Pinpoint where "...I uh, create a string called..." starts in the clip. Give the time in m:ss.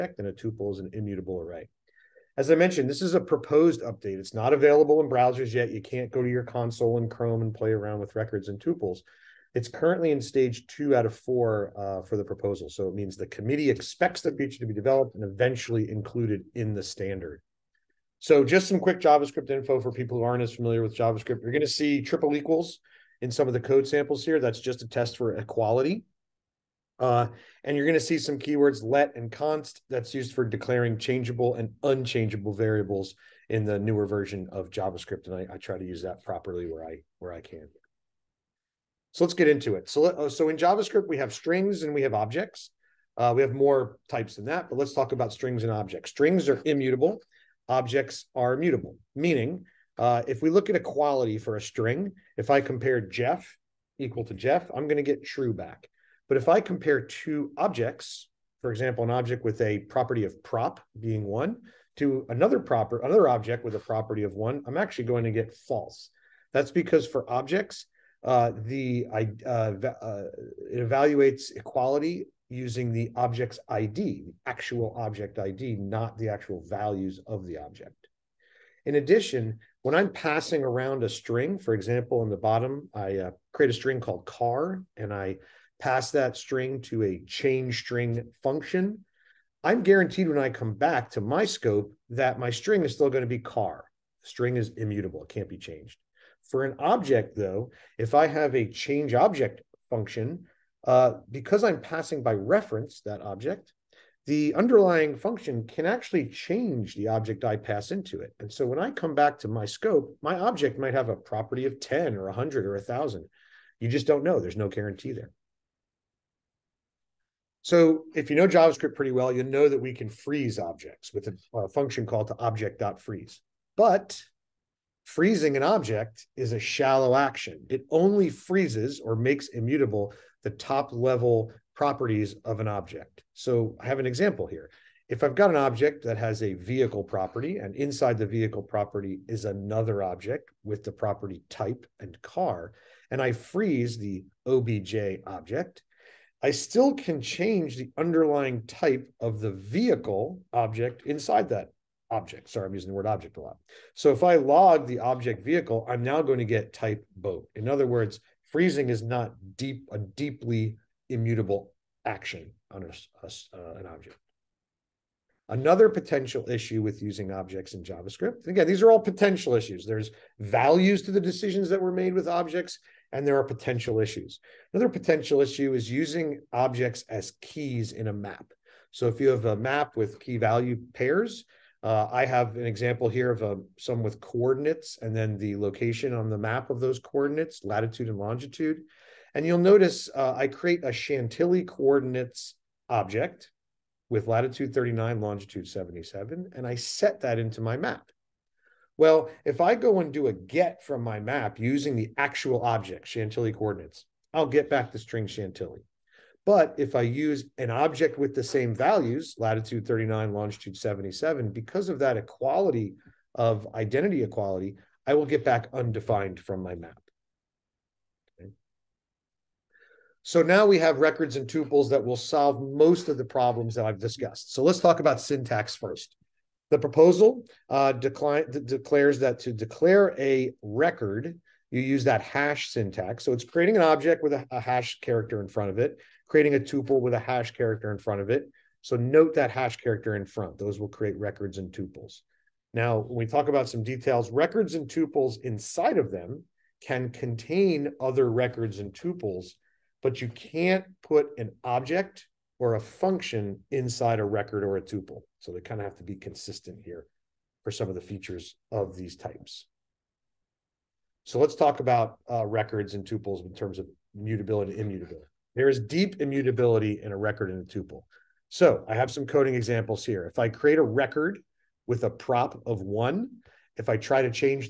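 1:22.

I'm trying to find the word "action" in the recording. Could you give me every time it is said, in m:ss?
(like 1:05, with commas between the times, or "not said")
2:07, 2:42.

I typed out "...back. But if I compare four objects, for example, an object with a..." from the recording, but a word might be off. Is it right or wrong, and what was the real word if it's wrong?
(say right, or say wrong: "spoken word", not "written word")
wrong: "two", not "four".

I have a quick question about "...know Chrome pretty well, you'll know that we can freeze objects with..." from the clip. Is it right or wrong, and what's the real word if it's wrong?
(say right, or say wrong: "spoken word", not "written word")
wrong: "JavaScript", not "Chrome".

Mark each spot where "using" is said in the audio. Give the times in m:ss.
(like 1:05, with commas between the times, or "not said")
1:12, 2:32, 2:47, 2:55, 3:21.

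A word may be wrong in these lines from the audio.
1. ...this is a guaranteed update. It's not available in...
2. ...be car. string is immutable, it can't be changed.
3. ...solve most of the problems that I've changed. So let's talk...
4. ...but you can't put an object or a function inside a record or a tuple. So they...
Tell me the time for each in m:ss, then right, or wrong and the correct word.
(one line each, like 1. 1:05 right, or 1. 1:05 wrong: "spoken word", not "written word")
1. 0:02 wrong: "proposed", not "guaranteed"
2. 1:33 right
3. 3:42 wrong: "discussed", not "changed"
4. 4:10 right.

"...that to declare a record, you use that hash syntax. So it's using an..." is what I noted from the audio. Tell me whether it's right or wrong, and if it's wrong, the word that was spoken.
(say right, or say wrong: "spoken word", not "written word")
wrong: "creating", not "using".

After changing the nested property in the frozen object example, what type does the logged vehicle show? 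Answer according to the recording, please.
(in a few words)
boat.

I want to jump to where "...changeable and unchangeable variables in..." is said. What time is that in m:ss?
0:30.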